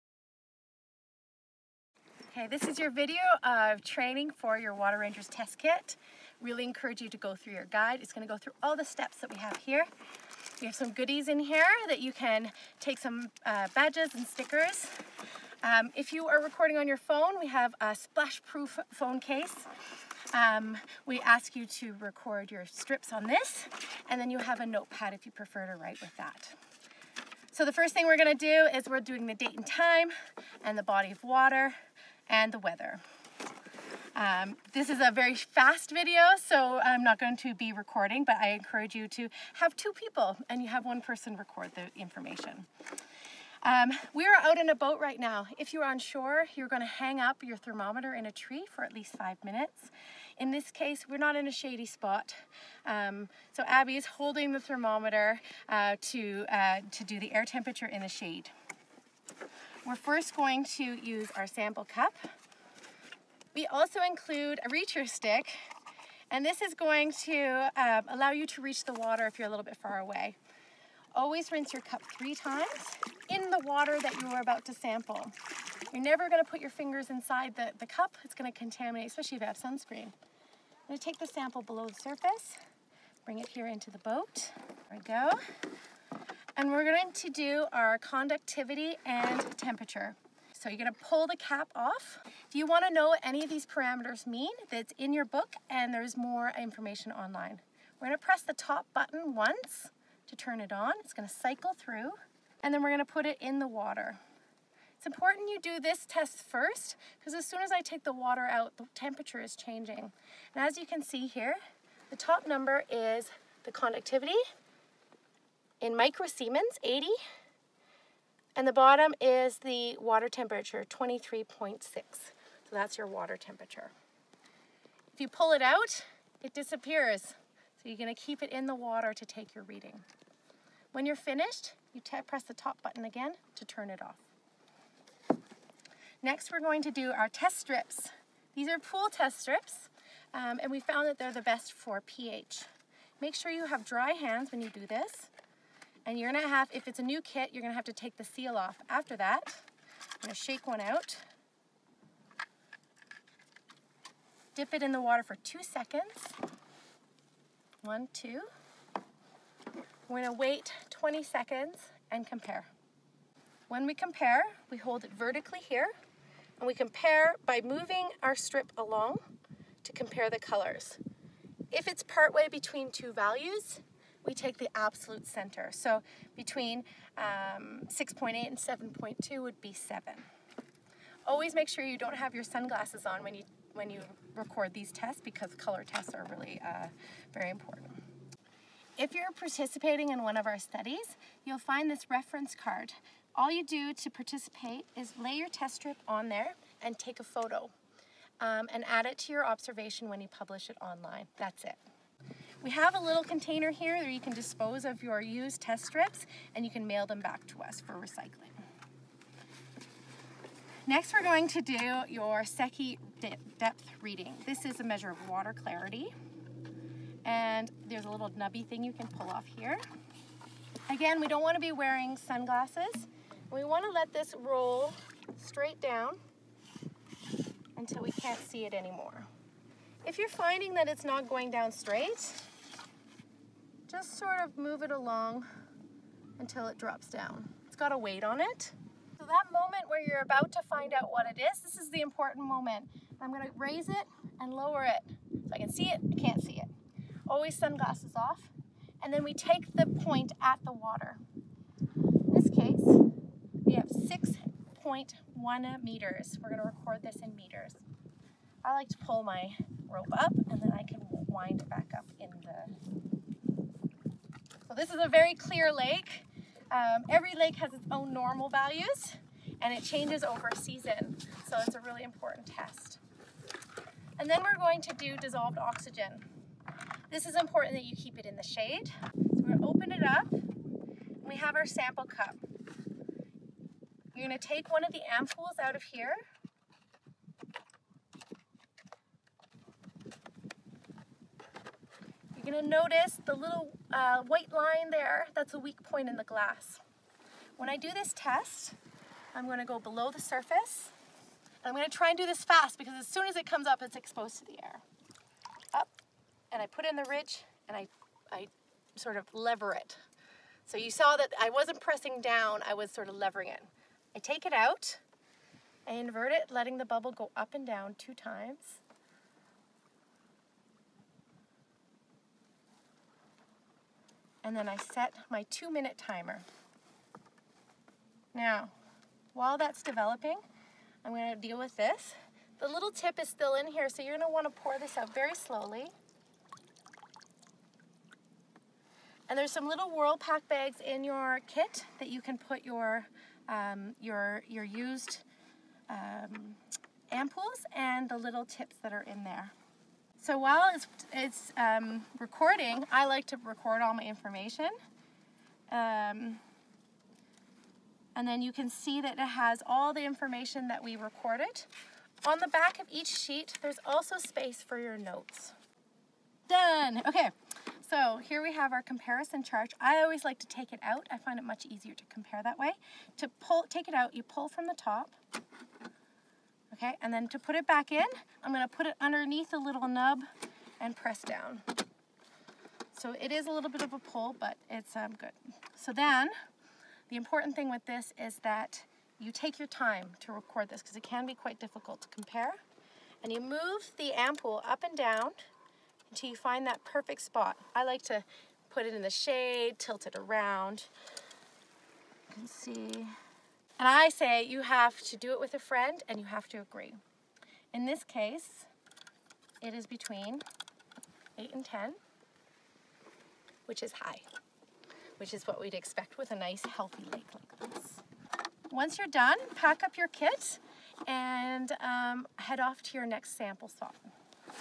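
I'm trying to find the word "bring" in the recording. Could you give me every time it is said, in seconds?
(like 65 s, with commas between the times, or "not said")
83 s.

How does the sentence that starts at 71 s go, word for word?
Always rinse your cup three times in the water that you are about to sample.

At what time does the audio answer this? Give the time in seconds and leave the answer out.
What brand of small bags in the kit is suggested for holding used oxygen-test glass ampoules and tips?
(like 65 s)
339 s.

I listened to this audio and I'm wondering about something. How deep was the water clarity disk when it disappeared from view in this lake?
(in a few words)
6.1 meters.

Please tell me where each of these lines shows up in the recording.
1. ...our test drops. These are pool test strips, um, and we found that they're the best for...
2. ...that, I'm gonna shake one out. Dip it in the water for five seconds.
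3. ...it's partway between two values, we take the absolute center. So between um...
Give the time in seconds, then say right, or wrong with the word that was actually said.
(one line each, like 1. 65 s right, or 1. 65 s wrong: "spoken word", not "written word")
1. 137 s wrong: "strips", not "drops"
2. 149 s wrong: "two", not "five"
3. 171 s right.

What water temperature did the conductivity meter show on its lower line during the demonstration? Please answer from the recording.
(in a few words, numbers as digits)
23.6.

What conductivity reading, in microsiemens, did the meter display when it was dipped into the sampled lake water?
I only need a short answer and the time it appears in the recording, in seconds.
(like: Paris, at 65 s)
80, at 116 s.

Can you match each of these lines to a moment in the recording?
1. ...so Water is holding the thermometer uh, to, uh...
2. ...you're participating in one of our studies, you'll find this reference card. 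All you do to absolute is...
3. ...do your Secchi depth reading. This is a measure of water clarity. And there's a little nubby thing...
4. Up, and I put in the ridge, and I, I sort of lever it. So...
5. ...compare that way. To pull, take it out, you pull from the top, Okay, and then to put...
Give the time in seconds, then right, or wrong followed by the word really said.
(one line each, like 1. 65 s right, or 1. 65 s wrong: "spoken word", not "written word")
1. 53 s wrong: "Abby", not "Water"
2. 189 s wrong: "participate", not "absolute"
3. 211 s right
4. 305 s right
5. 372 s right.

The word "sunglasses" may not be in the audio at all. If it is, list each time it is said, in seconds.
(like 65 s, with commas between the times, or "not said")
182 s, 222 s, 247 s.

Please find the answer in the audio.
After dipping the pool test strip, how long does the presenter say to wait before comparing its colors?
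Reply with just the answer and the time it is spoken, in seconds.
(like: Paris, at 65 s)
20 seconds, at 160 s.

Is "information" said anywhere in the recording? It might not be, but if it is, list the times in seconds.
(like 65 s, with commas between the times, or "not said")
42 s, 96 s, 354 s, 360 s.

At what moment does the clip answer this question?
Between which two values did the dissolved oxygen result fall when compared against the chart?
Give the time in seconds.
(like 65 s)
411 s.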